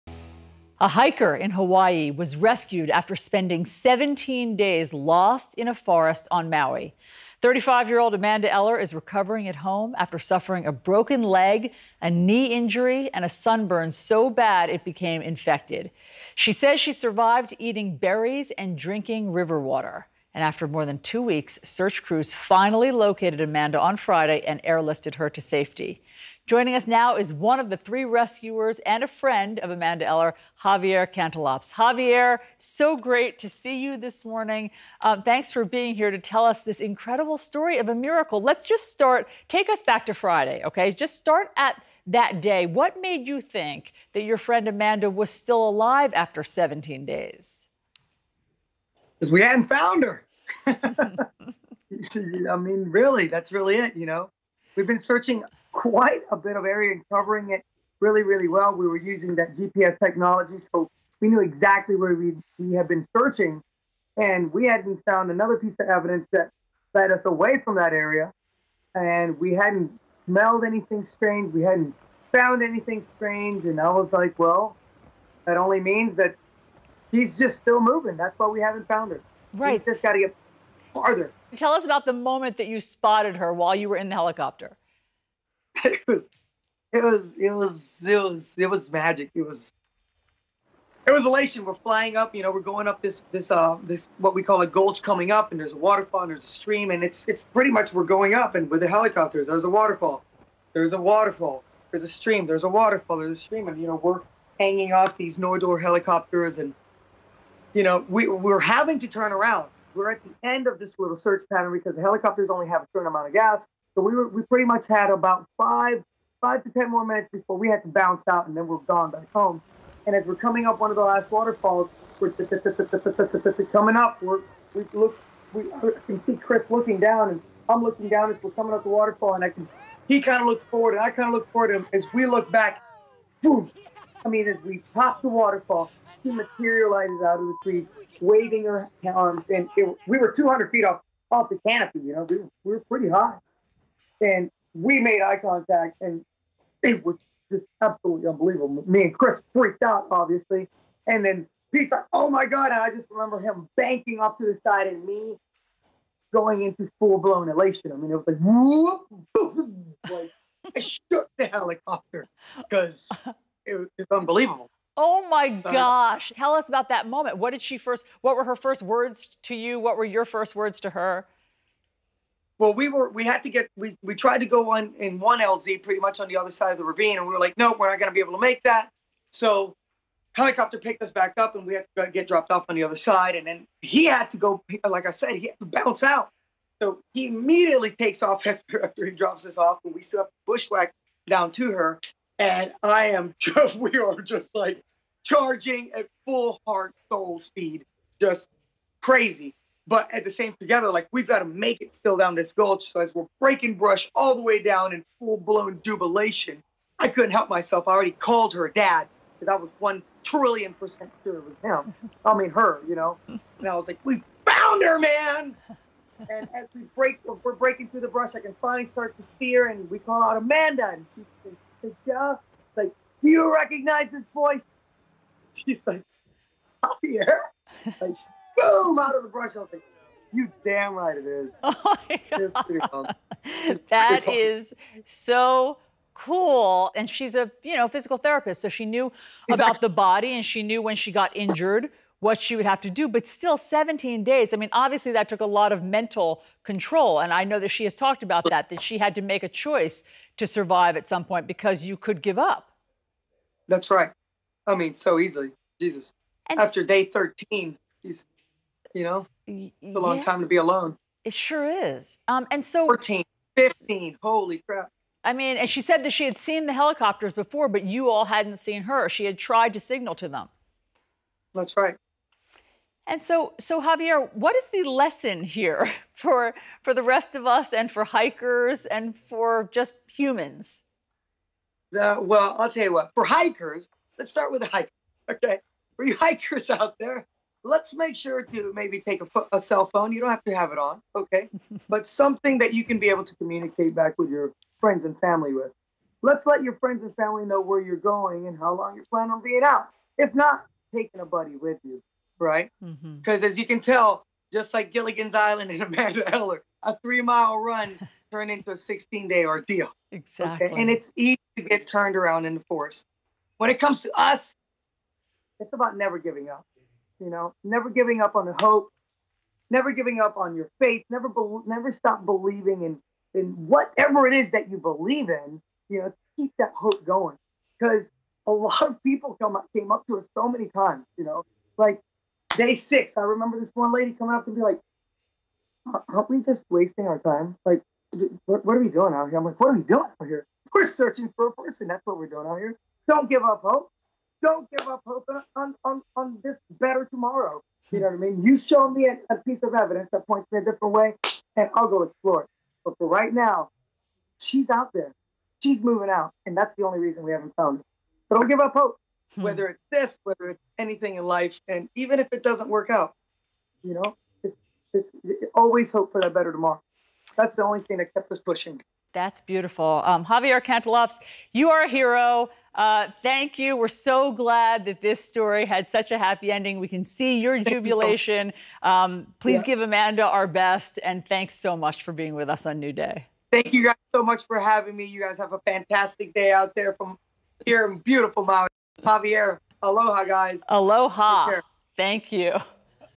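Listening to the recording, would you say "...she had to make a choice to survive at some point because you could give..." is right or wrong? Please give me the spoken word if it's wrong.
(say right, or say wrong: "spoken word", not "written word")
right.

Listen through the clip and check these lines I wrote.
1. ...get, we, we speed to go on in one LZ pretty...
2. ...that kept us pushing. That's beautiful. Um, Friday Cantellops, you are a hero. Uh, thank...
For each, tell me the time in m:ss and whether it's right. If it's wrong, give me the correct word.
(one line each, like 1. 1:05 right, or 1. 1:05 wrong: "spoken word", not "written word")
1. 2:53 wrong: "tried", not "speed"
2. 6:07 wrong: "Javier", not "Friday".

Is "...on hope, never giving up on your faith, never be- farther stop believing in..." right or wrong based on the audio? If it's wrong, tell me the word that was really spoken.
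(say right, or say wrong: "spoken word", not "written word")
wrong: "never", not "farther".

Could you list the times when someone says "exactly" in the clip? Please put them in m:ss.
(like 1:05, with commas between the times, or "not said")
1:01, 3:59, 5:10.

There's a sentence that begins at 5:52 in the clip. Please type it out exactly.
But for right now, she's out there.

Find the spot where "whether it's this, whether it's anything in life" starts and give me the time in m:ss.
5:59.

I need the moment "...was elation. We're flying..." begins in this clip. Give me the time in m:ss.
1:31.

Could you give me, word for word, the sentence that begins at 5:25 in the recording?
You know, keep that hope going because a lot of people come up, came up to us so many times.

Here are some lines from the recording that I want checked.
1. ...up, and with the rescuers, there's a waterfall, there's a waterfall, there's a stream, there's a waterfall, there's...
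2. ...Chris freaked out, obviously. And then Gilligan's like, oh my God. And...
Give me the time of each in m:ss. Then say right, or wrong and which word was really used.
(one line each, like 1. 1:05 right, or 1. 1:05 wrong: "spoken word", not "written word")
1. 1:38 wrong: "helicopters", not "rescuers"
2. 2:29 wrong: "Pete", not "Gilligan".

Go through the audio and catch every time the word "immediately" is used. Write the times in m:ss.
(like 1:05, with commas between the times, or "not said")
3:07.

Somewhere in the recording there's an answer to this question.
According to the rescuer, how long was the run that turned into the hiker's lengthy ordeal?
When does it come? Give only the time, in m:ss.
5:06.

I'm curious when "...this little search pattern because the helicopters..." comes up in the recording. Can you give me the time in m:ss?
1:50.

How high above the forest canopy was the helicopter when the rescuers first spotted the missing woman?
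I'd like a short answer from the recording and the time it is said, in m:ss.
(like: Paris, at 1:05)
200 feet, at 2:20.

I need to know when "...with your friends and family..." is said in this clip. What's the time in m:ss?
4:54.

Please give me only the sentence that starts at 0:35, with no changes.
Um, thanks for being here to tell us this incredible story of a miracle.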